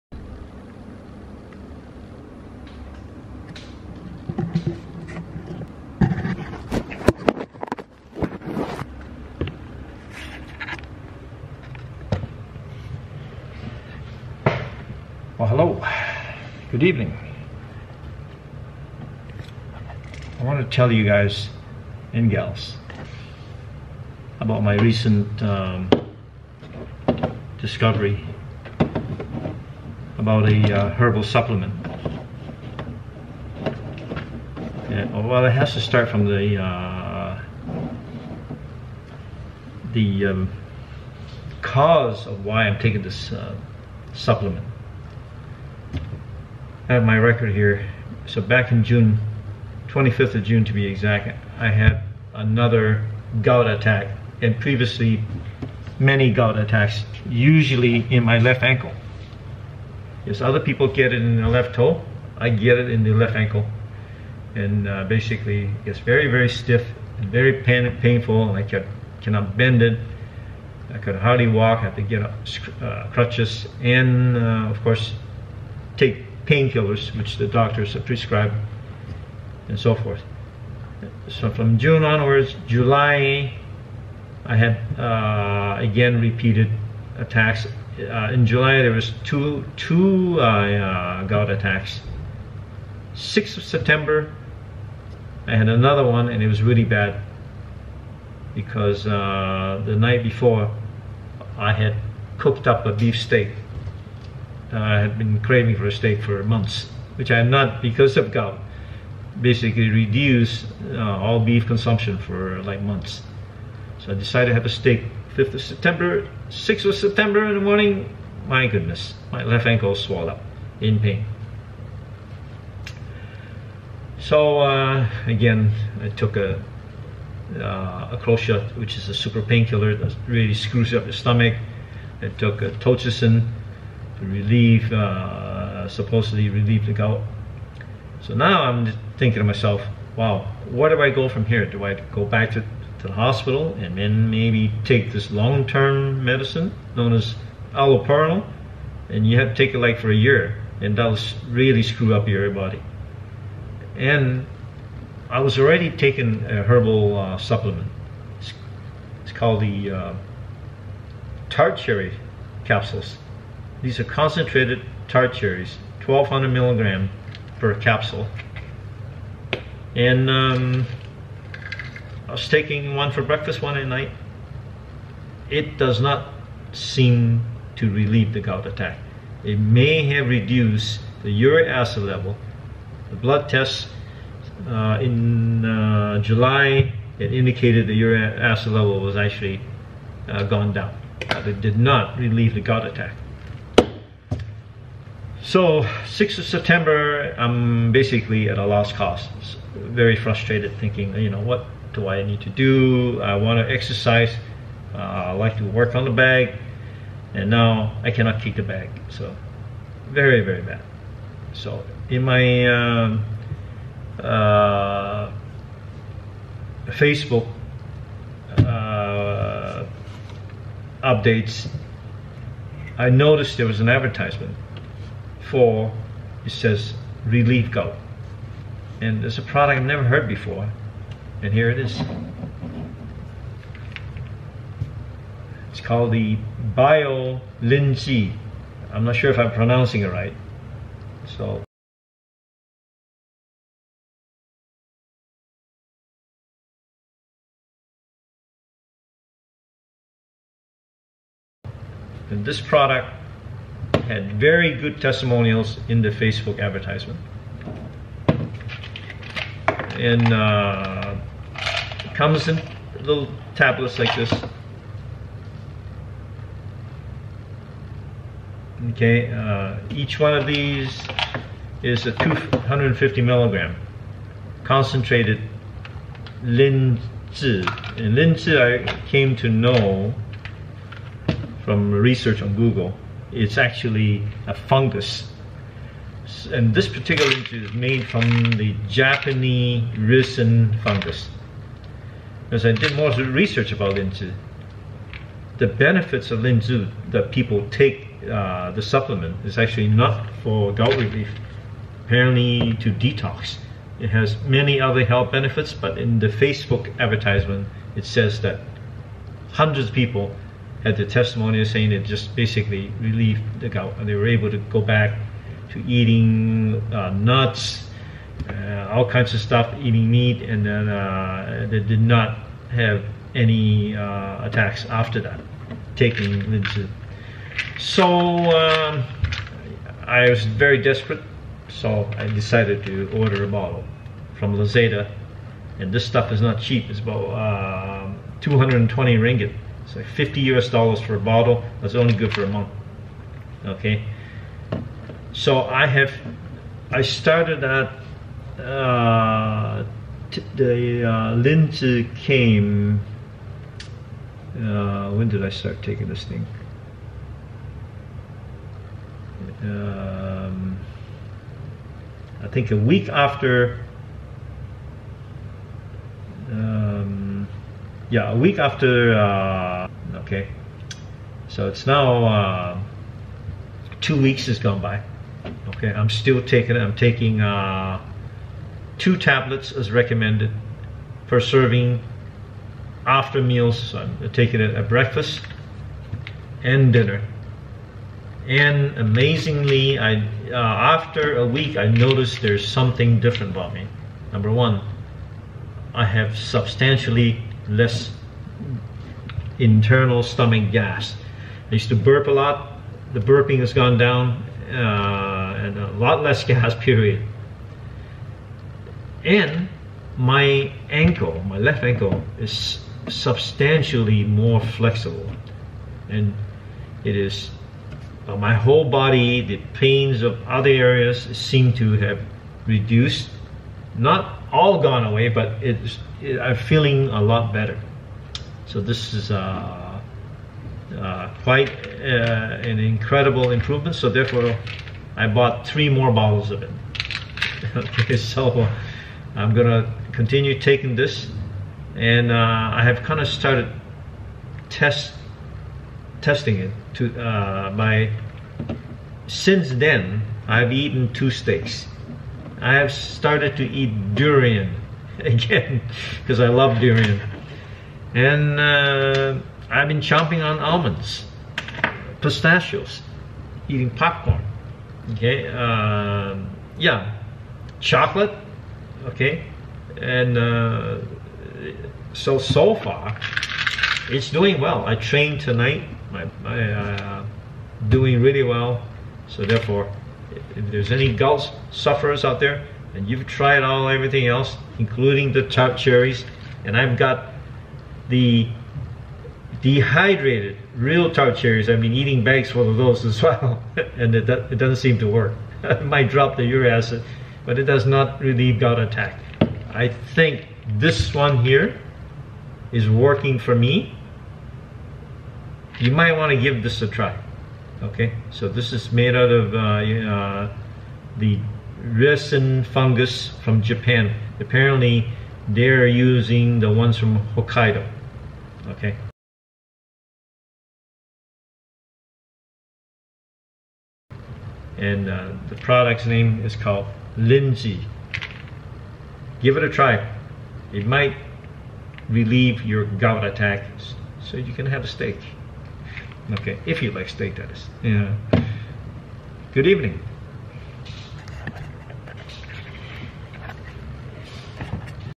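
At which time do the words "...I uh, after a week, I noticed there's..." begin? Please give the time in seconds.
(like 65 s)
389 s.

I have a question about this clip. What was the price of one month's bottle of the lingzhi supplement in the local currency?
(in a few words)
220 ringgit.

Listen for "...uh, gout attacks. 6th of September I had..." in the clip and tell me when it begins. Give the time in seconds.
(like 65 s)
90 s.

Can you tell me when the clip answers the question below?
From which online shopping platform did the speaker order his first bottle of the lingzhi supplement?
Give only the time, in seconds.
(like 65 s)
334 s.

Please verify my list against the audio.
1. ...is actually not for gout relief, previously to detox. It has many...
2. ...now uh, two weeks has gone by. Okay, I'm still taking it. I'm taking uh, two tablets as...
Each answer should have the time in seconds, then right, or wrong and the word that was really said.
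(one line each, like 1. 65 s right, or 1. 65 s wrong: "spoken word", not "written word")
1. 299 s wrong: "apparently", not "previously"
2. 371 s right.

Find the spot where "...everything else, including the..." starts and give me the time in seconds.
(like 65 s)
483 s.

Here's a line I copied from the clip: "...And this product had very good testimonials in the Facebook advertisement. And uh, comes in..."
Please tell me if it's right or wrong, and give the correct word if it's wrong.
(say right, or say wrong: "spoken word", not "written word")
right.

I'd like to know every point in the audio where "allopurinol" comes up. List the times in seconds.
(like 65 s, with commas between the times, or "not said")
147 s.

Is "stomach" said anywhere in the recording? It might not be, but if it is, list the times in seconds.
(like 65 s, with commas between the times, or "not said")
131 s, 400 s.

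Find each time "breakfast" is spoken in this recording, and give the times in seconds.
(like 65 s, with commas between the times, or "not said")
173 s, 384 s.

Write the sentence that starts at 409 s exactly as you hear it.
And my ankle, my left ankle, is substantially more flexible.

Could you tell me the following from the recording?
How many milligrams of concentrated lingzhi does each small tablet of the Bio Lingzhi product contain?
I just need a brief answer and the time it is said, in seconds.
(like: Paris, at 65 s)
250 milligrams, at 272 s.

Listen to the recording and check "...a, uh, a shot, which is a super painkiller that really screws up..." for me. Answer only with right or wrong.
right.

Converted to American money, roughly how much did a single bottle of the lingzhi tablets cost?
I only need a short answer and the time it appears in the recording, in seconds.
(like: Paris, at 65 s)
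50 US dollars, at 340 s.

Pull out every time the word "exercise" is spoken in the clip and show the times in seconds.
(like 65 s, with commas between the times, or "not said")
203 s.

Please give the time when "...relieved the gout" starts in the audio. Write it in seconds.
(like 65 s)
312 s.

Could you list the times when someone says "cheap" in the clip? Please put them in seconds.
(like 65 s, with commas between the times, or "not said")
336 s.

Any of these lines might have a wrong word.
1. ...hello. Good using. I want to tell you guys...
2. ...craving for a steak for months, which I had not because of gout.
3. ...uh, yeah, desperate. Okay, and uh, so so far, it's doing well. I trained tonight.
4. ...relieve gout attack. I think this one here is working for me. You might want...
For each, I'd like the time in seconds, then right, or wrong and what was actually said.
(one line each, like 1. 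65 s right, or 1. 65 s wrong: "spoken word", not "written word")
1. 15 s wrong: "evening", not "using"
2. 105 s right
3. 465 s wrong: "chocolate", not "desperate"
4. 498 s right.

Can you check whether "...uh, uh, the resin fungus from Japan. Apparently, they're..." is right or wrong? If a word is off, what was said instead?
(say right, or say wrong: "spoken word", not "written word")
right.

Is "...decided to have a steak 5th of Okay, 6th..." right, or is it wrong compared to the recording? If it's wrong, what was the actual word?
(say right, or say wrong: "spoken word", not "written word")
wrong: "September", not "Okay".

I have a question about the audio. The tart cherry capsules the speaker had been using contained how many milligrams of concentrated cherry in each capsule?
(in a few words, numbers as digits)
1200 milligrams.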